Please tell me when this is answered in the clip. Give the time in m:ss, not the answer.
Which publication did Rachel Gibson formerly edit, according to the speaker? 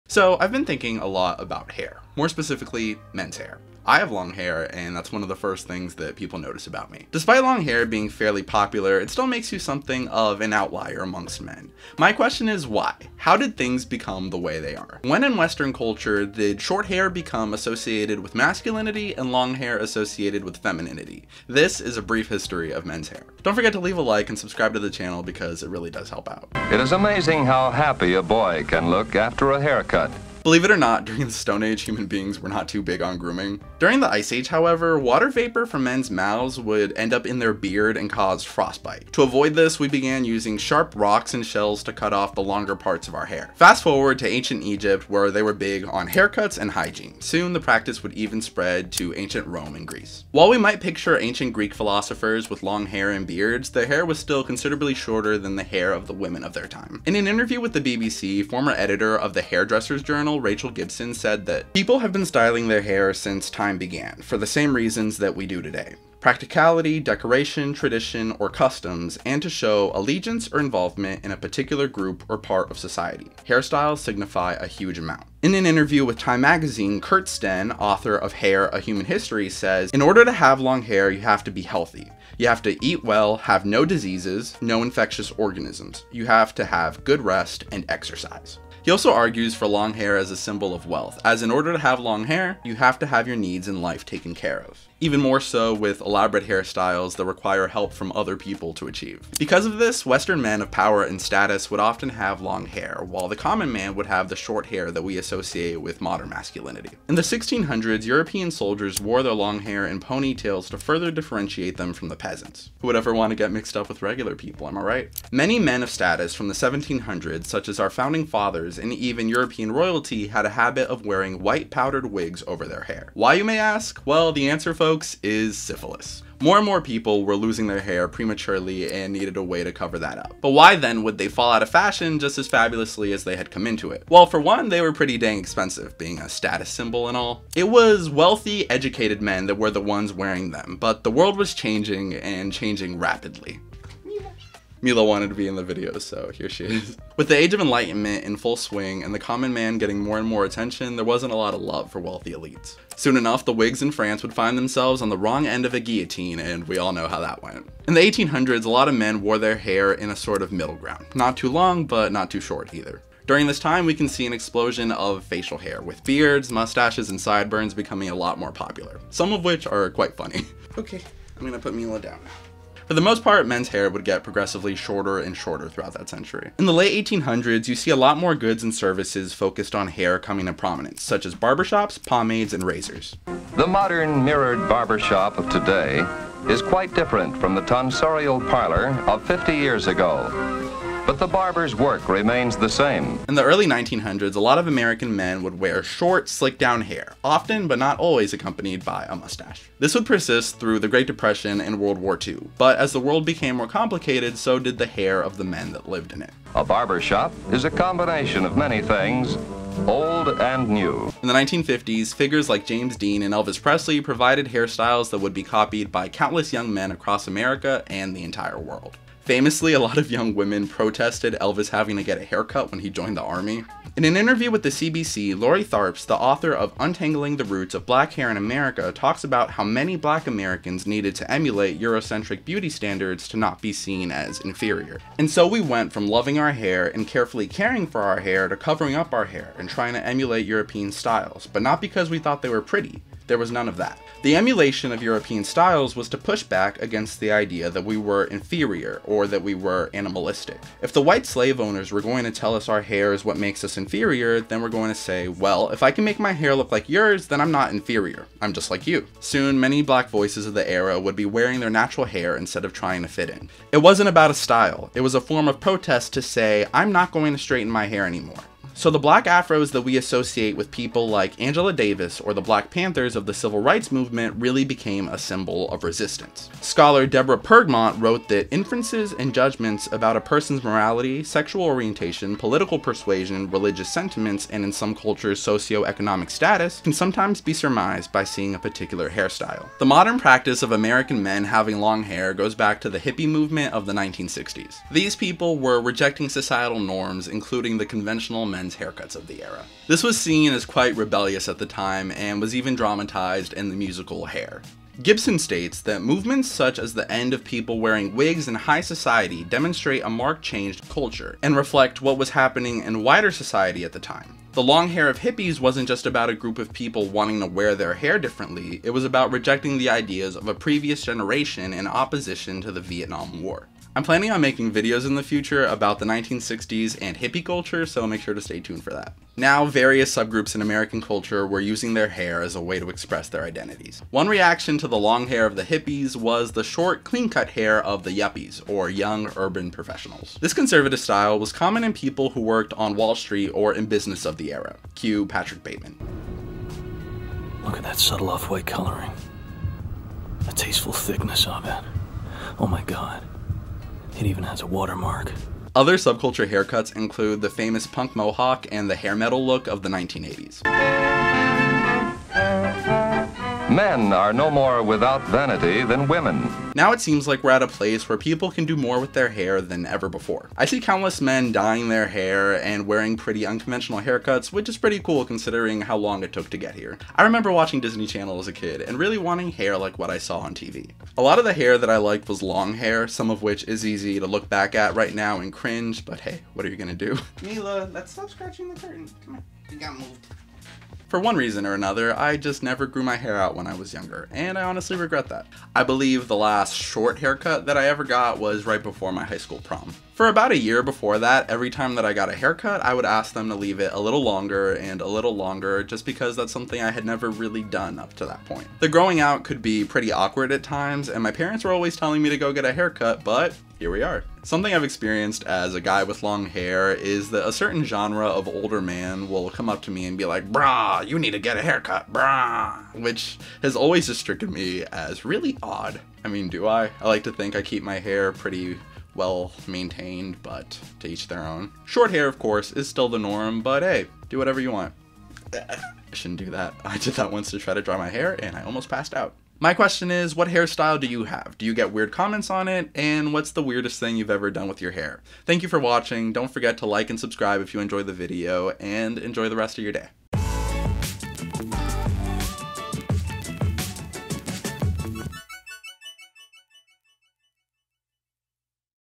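0:59.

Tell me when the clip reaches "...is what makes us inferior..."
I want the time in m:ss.
4:13.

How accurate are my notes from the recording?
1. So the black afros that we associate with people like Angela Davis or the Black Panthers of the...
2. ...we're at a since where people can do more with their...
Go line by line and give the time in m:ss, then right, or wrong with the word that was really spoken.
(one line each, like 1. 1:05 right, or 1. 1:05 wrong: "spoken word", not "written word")
1. 4:28 right
2. 6:07 wrong: "place", not "since".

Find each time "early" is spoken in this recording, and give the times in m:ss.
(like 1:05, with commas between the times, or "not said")
3:13.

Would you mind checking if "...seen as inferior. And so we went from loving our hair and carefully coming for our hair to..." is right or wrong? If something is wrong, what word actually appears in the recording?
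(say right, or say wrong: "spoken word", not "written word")
wrong: "caring", not "coming".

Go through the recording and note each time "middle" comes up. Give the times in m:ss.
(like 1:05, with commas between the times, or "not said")
2:40.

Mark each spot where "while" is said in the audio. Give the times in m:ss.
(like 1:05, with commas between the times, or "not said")
0:50, 1:43.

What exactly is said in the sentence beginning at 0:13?
How did things become the way they are?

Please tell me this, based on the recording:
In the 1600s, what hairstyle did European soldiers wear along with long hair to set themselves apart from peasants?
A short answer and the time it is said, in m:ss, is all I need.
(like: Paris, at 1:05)
Ponytails, at 1:50.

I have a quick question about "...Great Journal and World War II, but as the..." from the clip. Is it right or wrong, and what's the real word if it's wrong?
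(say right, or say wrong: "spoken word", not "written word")
wrong: "Depression", not "Journal".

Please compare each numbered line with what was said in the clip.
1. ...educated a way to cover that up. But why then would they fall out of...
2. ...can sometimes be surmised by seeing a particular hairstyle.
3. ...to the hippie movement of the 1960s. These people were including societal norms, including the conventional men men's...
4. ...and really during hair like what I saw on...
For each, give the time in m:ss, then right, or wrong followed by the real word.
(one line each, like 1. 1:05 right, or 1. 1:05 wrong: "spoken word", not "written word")
1. 2:09 wrong: "needed", not "educated"
2. 4:46 right
3. 4:52 wrong: "rejecting", not "including"
4. 6:18 wrong: "wanting", not "during".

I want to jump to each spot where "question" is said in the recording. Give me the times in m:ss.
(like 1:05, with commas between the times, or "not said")
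0:12, 7:19.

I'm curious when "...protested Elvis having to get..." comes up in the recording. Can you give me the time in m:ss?
3:40.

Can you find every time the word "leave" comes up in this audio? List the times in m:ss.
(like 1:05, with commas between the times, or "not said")
0:23, 6:43.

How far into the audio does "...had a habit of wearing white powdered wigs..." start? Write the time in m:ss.
2:00.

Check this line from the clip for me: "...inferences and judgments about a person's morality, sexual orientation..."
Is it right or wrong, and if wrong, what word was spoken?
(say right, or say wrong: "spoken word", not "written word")
right.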